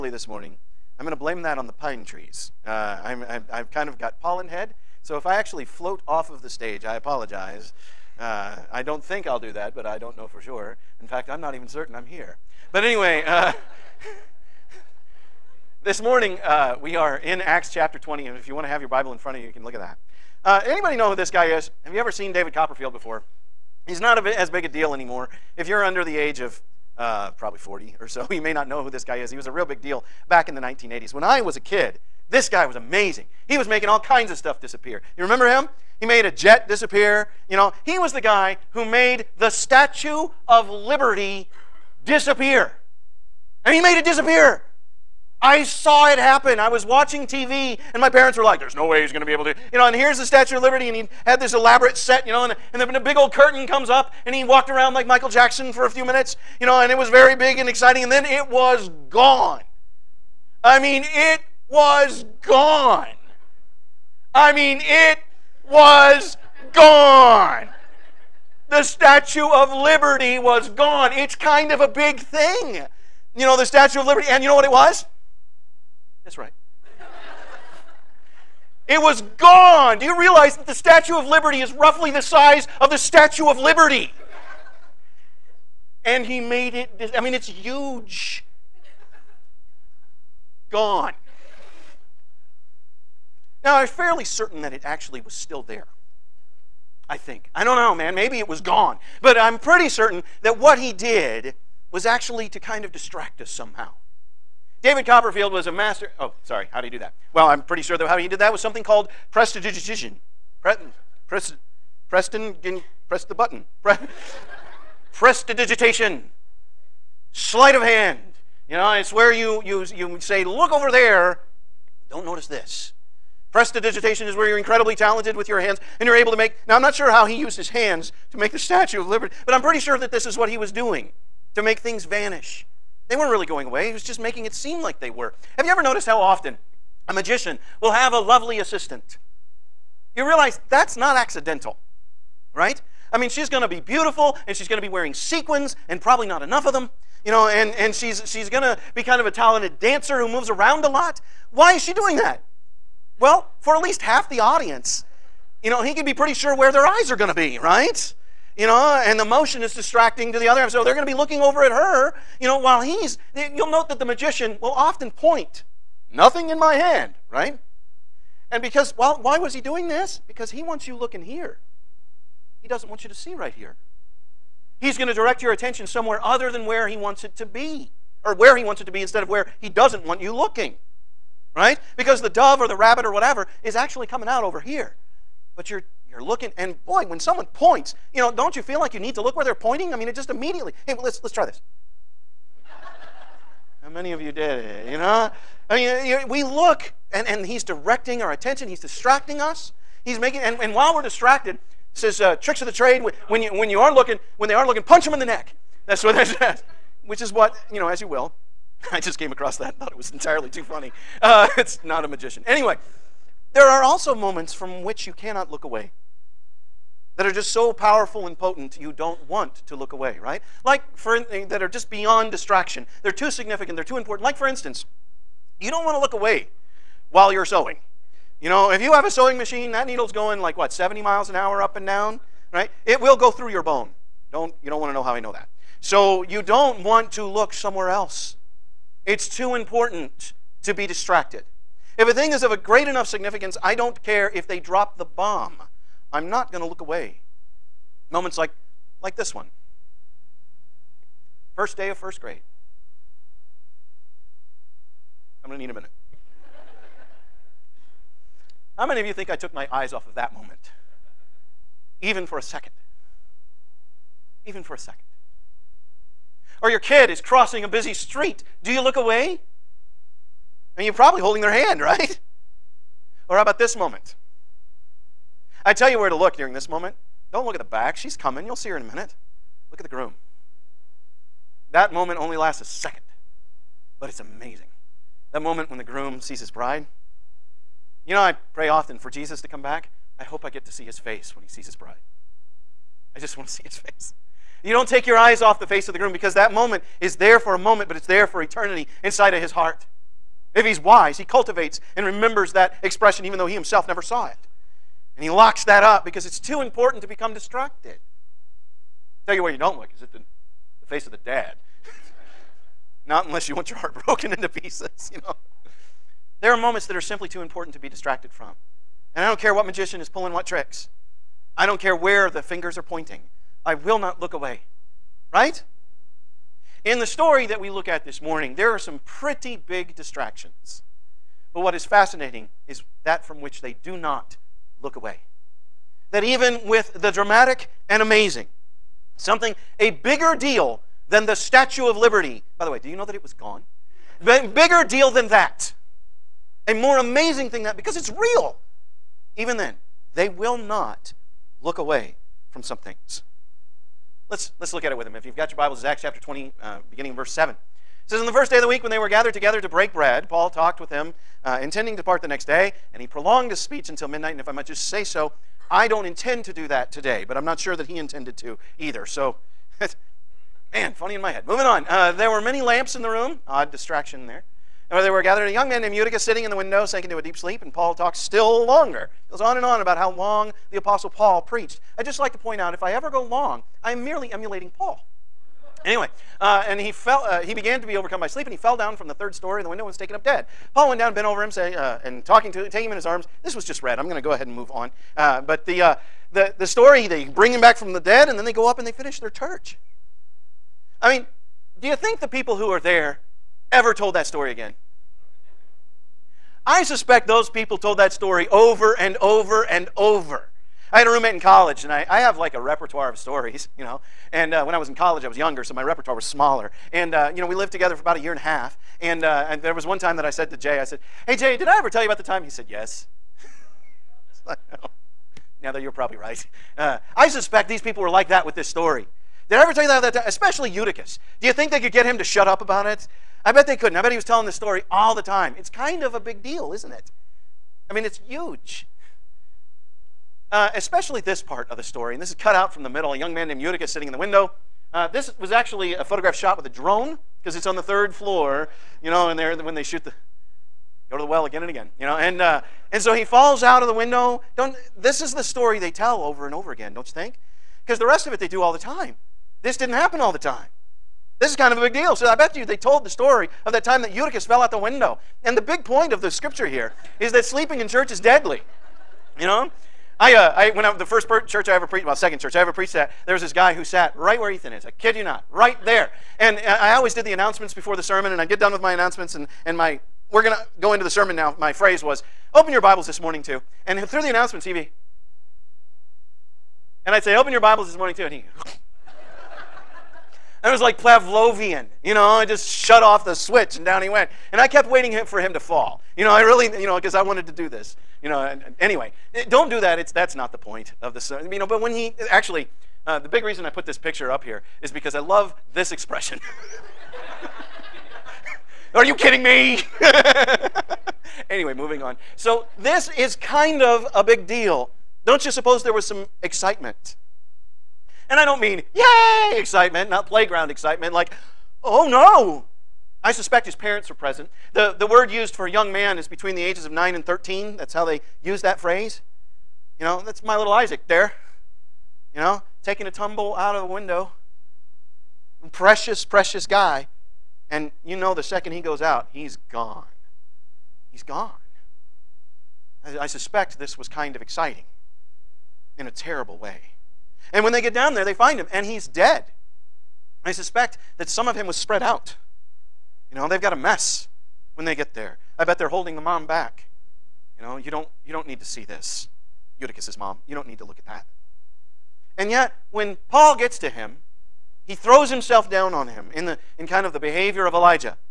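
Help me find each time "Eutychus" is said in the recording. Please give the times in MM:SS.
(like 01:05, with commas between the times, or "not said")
06:15, 07:10, 07:23, 07:44, 09:19.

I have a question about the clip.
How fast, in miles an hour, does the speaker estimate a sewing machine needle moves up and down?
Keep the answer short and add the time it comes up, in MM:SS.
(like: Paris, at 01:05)
70, at 03:50.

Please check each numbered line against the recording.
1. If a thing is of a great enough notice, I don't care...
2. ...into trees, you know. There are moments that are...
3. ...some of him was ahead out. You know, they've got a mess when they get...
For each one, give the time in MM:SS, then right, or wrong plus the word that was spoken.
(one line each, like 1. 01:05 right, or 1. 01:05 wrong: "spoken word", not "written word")
1. 04:01 wrong: "significance", not "notice"
2. 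05:14 wrong: "pieces", not "trees"
3. 09:11 wrong: "spread", not "ahead".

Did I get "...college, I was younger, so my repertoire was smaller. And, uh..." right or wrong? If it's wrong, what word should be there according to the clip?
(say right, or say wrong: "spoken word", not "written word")
right.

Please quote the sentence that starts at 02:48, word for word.
And because, well, why was he doing this?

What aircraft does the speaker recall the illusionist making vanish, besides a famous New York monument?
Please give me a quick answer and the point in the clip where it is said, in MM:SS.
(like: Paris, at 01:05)
A jet, at 00:36.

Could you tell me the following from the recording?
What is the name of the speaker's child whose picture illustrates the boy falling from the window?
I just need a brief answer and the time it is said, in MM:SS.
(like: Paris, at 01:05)
Isaac, at 08:50.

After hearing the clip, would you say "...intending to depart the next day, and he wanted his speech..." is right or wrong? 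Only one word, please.
wrong.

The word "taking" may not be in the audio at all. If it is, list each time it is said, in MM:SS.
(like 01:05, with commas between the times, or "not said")
06:32, 08:52.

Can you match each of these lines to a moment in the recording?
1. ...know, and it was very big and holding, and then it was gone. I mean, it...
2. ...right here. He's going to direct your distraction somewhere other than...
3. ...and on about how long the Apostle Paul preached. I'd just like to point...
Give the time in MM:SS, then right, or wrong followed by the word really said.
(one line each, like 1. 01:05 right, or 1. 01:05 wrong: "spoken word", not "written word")
1. 00:56 wrong: "exciting", not "holding"
2. 02:53 wrong: "attention", not "distraction"
3. 06:19 right.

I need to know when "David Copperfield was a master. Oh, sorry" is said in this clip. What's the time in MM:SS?
01:44.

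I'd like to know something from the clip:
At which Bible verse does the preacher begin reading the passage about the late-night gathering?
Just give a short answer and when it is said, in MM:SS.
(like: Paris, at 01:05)
Verse 7, at 05:57.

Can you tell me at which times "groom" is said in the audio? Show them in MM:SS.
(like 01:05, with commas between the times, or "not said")
04:39, 04:45, 04:55.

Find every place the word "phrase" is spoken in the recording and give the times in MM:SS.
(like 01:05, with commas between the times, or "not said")
08:01, 08:48.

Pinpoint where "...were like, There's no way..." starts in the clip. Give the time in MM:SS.
00:48.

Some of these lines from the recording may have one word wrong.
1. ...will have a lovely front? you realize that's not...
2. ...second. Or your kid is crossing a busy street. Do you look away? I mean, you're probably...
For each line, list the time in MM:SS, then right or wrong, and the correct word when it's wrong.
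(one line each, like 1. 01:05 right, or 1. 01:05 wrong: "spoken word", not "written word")
1. 02:17 wrong: "assistant", not "front"
2. 04:24 right.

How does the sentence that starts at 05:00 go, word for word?
If he's wise, he cultivates and remembers that expression even though he himself never saw it.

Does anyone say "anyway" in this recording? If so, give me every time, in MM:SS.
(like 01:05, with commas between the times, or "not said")
00:12, 03:32, 06:25, 08:18, 08:31.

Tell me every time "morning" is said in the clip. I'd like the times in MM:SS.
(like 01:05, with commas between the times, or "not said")
00:00, 00:16, 05:28, 08:03, 08:07.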